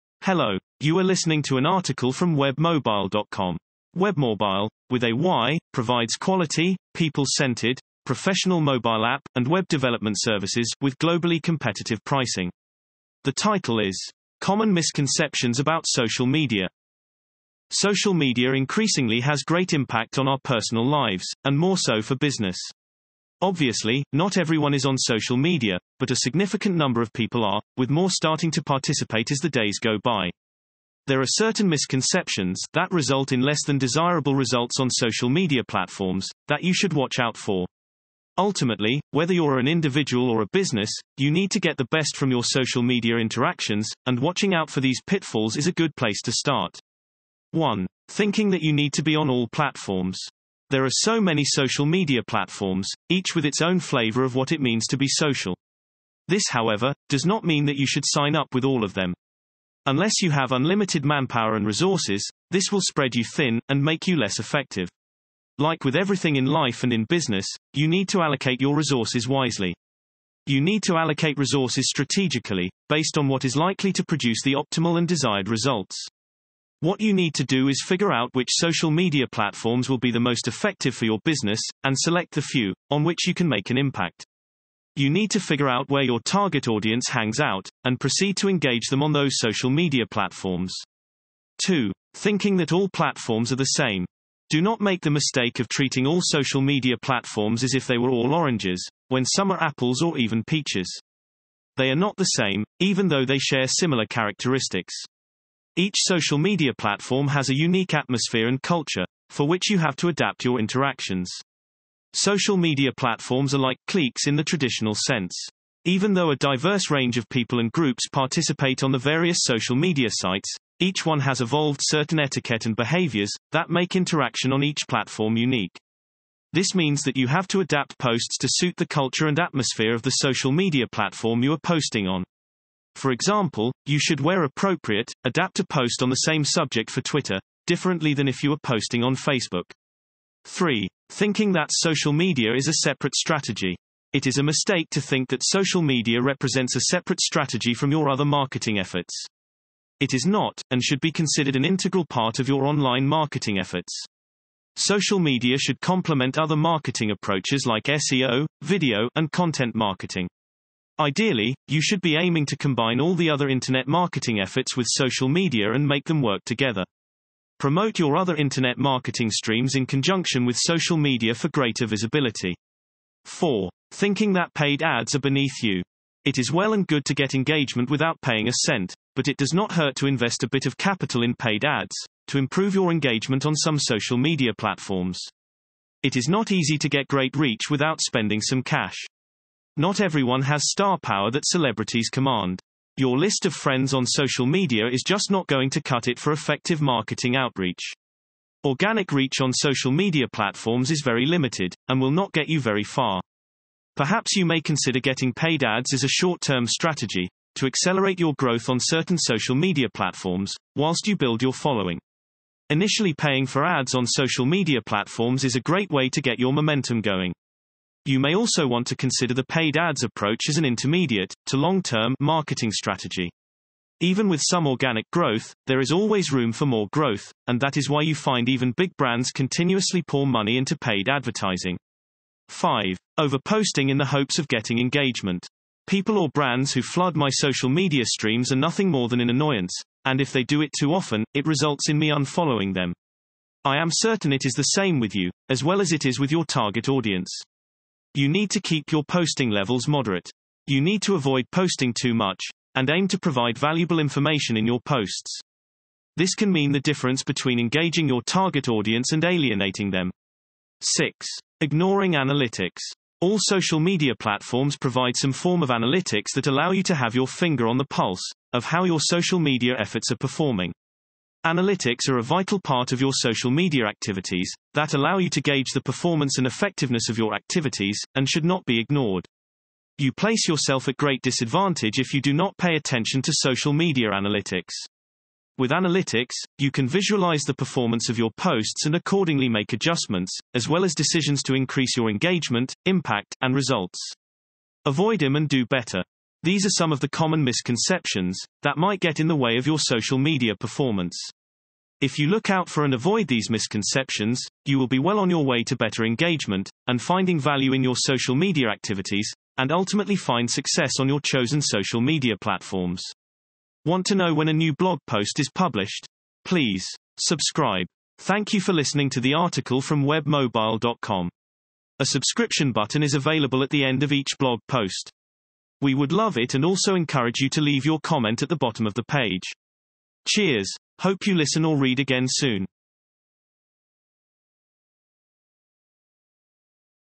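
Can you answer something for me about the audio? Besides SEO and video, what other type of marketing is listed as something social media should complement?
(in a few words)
content marketing.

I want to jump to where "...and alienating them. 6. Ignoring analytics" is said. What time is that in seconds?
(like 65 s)
259 s.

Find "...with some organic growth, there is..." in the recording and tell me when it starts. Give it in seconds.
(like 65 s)
224 s.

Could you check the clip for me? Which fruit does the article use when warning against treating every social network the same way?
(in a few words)
oranges.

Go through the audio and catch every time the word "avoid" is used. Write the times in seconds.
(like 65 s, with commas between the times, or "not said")
251 s, 294 s, 302 s.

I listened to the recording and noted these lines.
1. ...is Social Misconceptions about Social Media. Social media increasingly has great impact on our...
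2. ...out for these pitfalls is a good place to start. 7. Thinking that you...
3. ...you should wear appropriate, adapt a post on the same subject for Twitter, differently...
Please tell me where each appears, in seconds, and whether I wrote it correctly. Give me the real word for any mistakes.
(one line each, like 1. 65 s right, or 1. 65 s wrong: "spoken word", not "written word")
1. 13 s wrong: "Common", not "Social"
2. 44 s wrong: "1", not "7"
3. 133 s right.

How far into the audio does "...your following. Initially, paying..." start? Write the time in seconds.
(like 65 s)
211 s.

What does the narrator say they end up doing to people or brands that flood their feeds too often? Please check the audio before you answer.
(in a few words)
unfollowing them.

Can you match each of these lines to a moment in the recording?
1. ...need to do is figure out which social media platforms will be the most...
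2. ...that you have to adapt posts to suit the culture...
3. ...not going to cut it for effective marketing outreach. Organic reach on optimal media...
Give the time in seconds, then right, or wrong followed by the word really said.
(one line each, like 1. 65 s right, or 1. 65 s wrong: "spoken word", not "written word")
1. 77 s right
2. 127 s right
3. 195 s wrong: "social", not "optimal".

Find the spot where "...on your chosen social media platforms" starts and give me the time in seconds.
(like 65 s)
310 s.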